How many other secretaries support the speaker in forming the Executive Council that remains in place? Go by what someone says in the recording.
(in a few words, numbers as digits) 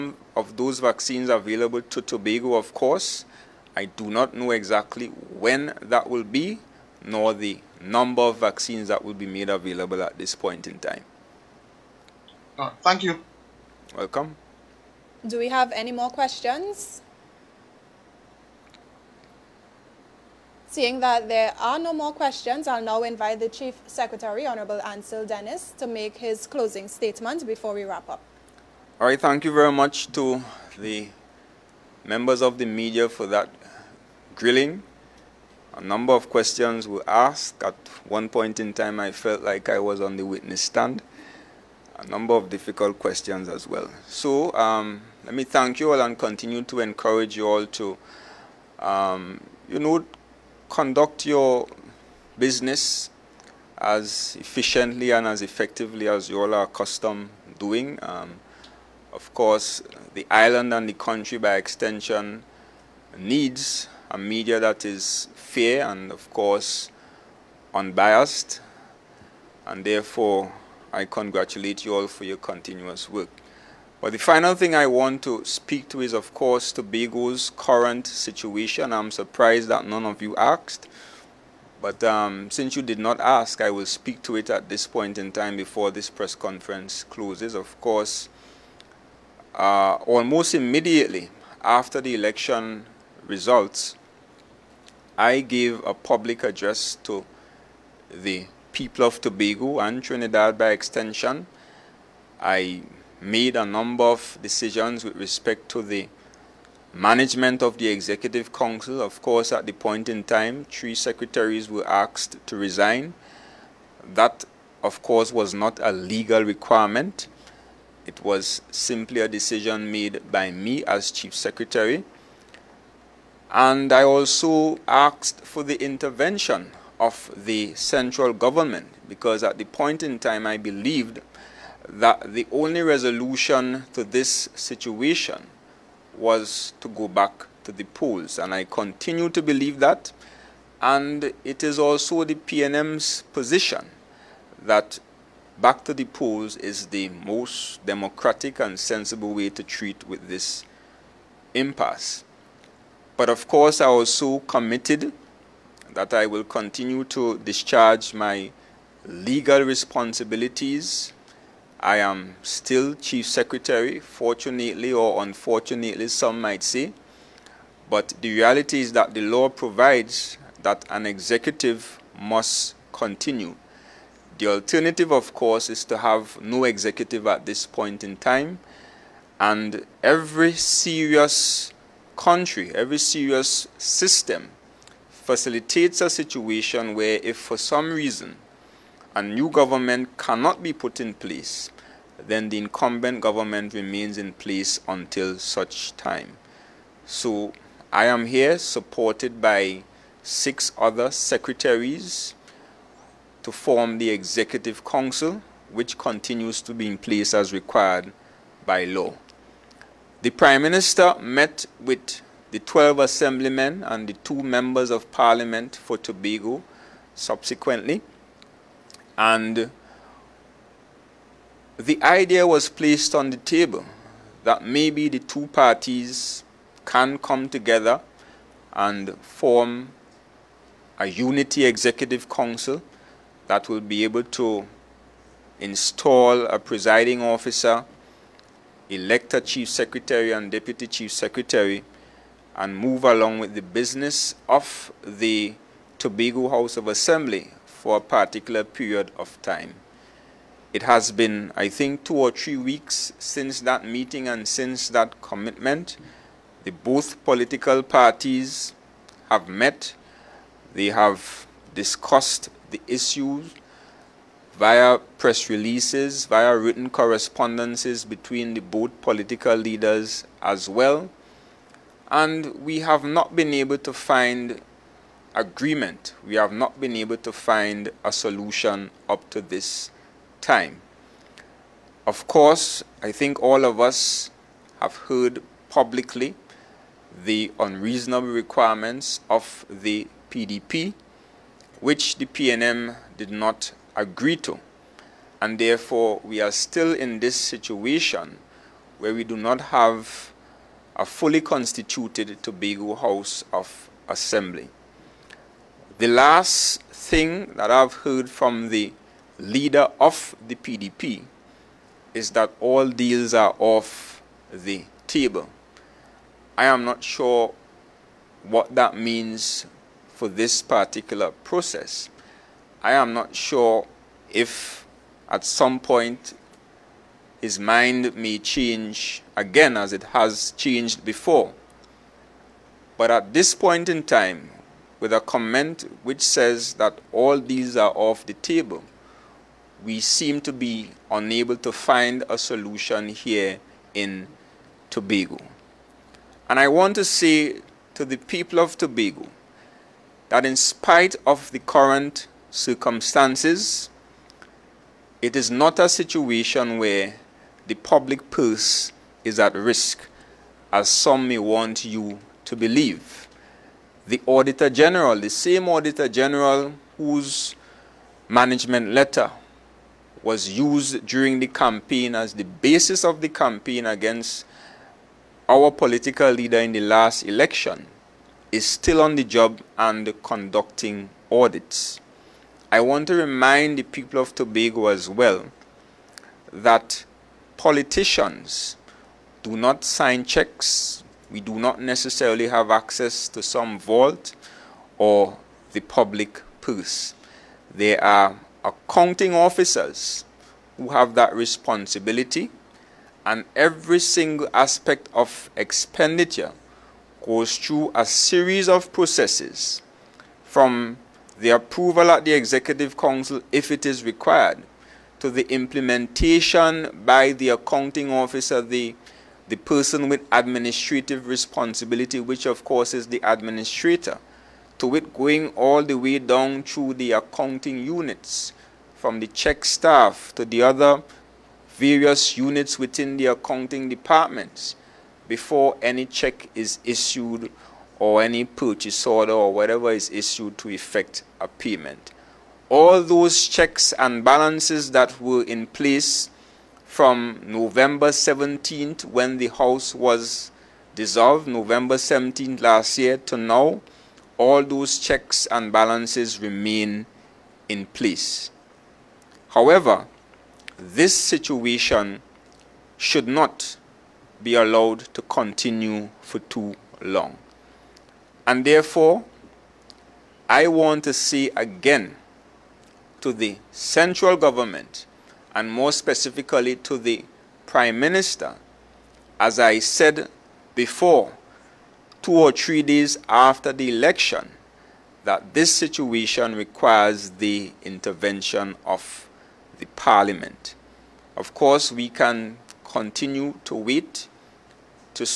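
6.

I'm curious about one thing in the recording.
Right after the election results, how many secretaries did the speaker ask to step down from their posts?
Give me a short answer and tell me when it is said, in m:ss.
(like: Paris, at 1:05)
3, at 1:50.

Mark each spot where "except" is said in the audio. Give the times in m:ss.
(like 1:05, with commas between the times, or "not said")
not said.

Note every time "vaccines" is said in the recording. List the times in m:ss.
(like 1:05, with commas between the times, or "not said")
0:00, 0:08.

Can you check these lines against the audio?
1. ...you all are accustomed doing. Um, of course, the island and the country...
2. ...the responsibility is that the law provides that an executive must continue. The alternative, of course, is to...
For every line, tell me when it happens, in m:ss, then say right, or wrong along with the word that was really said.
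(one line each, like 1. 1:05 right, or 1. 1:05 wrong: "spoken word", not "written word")
1. 0:56 right
2. 2:48 wrong: "reality", not "responsibility".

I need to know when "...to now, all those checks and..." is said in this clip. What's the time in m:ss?
7:33.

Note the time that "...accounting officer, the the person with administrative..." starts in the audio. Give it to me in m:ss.
6:57.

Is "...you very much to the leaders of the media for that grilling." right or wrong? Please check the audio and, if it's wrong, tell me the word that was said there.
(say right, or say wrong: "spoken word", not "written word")
wrong: "members", not "leaders".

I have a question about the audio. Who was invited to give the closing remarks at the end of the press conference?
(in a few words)
Ansel Dennis.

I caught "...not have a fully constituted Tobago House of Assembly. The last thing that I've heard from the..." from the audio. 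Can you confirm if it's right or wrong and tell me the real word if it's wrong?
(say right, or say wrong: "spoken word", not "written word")
right.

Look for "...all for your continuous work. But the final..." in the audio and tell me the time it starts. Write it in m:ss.
1:11.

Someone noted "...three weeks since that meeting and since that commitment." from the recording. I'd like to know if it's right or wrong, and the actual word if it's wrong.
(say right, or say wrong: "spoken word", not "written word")
right.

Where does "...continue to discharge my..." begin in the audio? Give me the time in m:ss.
2:36.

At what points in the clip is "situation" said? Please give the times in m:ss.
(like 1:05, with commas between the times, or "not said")
1:18, 2:14, 3:06, 4:57, 5:55, 7:41, 8:05.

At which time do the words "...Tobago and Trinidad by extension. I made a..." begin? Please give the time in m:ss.
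1:39.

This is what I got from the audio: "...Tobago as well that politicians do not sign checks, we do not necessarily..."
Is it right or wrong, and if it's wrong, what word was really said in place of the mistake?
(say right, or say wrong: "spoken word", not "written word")
right.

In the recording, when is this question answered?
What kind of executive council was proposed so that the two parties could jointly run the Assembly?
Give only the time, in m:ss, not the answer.
3:51.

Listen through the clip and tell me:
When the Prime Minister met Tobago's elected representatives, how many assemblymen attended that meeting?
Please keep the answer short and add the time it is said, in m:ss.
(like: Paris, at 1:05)
12, at 3:32.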